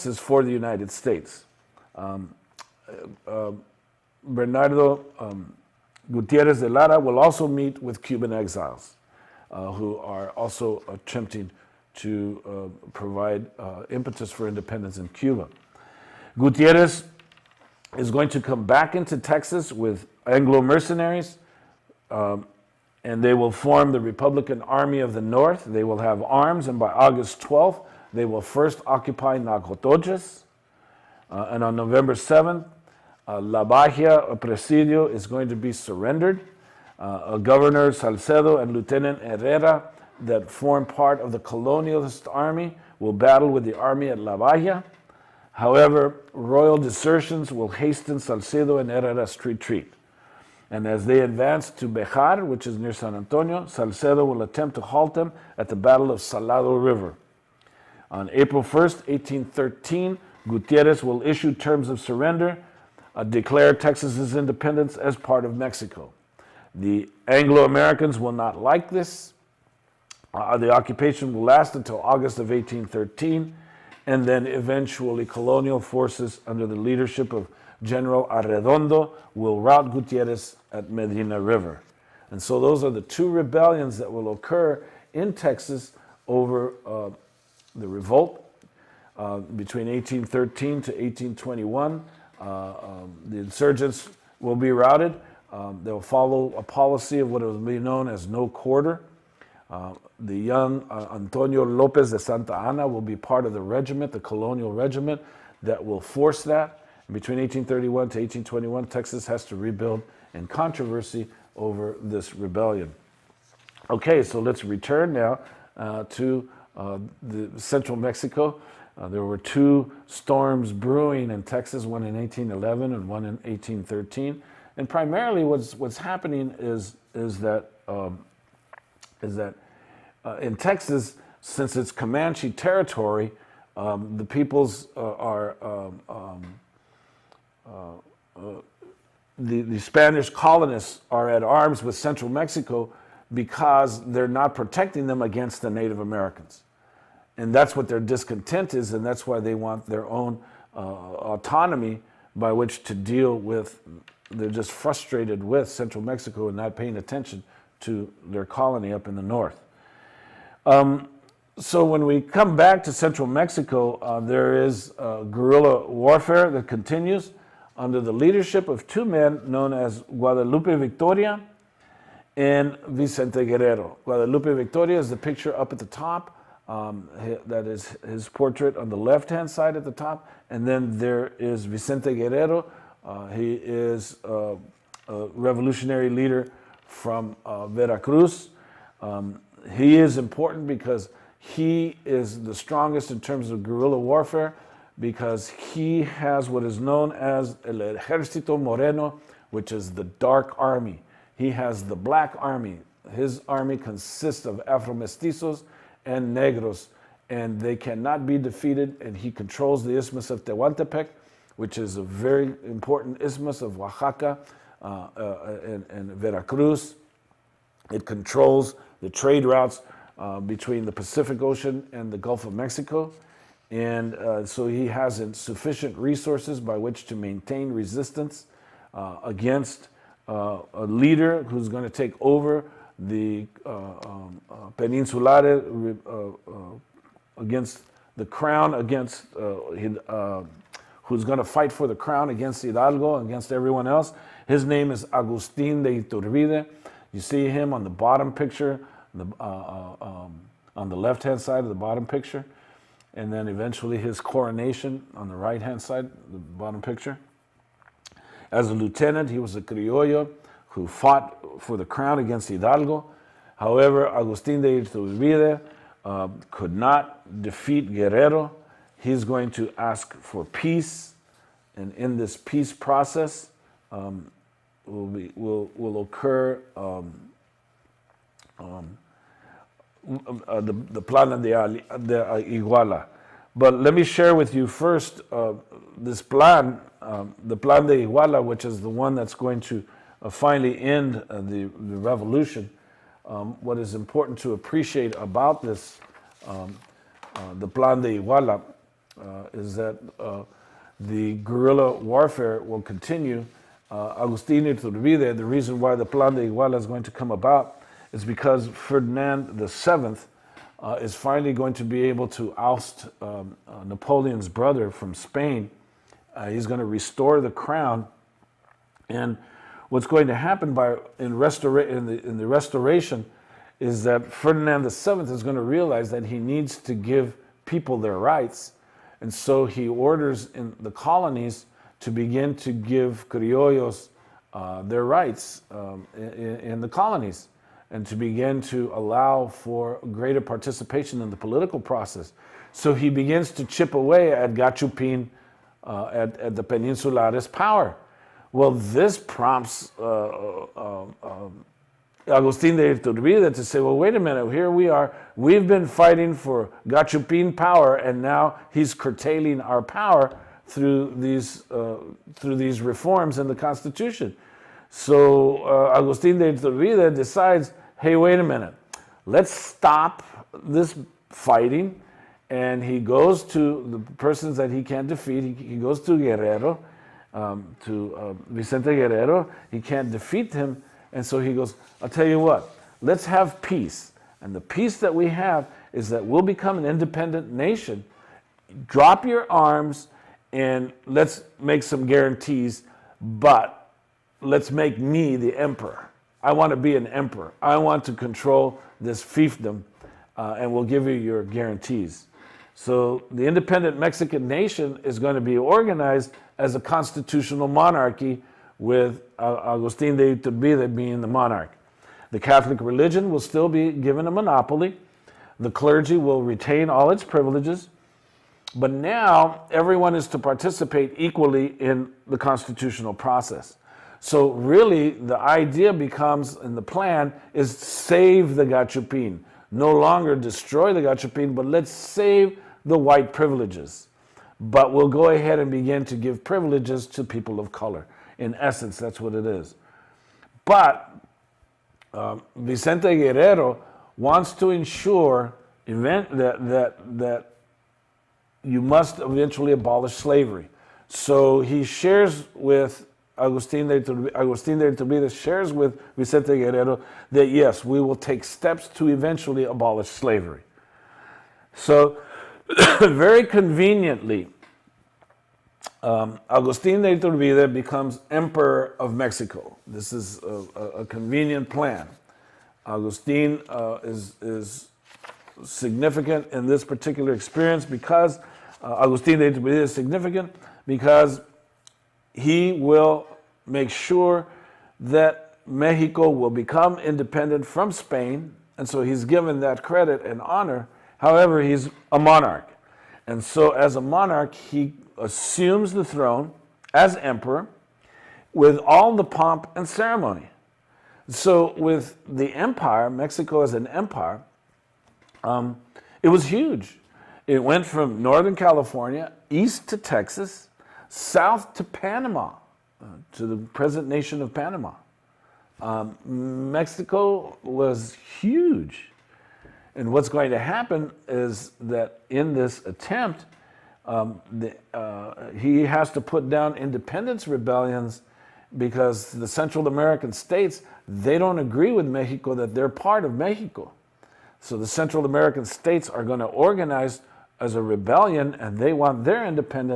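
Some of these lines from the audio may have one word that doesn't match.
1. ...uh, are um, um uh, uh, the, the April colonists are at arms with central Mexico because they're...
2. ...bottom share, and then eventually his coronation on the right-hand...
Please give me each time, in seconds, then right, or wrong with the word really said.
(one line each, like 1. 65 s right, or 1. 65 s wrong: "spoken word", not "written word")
1. 134 s wrong: "Spanish", not "April"
2. 251 s wrong: "picture", not "share".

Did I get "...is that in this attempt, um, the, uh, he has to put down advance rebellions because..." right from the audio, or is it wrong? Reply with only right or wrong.
wrong.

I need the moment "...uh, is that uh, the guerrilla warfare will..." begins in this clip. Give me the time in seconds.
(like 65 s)
299 s.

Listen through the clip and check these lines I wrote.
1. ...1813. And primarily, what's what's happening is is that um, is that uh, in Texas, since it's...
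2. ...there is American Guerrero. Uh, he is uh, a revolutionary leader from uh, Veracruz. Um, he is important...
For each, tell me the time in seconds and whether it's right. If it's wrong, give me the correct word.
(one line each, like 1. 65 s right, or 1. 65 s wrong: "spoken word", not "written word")
1. 123 s right
2. 180 s wrong: "Vicente", not "American".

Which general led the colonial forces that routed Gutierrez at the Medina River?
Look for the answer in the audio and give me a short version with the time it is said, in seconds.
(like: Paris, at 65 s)
General Arredondo, at 77 s.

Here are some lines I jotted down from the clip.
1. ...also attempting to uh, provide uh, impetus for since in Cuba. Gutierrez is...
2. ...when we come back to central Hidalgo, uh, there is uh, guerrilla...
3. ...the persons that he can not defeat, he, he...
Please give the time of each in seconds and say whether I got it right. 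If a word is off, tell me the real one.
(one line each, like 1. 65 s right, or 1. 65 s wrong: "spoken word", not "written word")
1. 10 s wrong: "independence", not "since"
2. 161 s wrong: "Mexico", not "Hidalgo"
3. 374 s right.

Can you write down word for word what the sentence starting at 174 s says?
Guadalupe Victoria is the picture up at the top.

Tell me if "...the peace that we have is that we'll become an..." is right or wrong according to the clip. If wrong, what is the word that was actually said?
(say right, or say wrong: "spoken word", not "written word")
right.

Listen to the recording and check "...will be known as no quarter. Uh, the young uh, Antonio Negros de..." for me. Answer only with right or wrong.
wrong.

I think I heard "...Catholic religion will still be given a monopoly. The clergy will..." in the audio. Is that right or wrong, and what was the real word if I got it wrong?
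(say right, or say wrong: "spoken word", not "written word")
right.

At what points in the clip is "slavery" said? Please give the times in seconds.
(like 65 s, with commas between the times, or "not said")
450 s, 460 s.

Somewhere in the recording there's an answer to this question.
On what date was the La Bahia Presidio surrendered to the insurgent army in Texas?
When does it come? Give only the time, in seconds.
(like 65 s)
31 s.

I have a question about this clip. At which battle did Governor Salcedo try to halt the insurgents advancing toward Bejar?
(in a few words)
Battle of Salado River.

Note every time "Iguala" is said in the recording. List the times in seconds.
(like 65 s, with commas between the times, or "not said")
281 s, 288 s, 298 s, 306 s.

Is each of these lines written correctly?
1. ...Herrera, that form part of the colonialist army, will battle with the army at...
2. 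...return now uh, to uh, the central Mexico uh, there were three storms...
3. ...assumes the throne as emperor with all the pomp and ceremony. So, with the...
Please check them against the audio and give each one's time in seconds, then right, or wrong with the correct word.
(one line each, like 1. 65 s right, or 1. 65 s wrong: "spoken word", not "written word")
1. 39 s right
2. 114 s wrong: "two", not "three"
3. 495 s right.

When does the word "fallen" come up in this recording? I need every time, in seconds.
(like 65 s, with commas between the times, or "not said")
not said.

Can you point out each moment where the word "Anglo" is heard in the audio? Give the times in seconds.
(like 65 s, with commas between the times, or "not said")
20 s, 67 s.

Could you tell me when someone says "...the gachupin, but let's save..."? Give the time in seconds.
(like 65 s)
430 s.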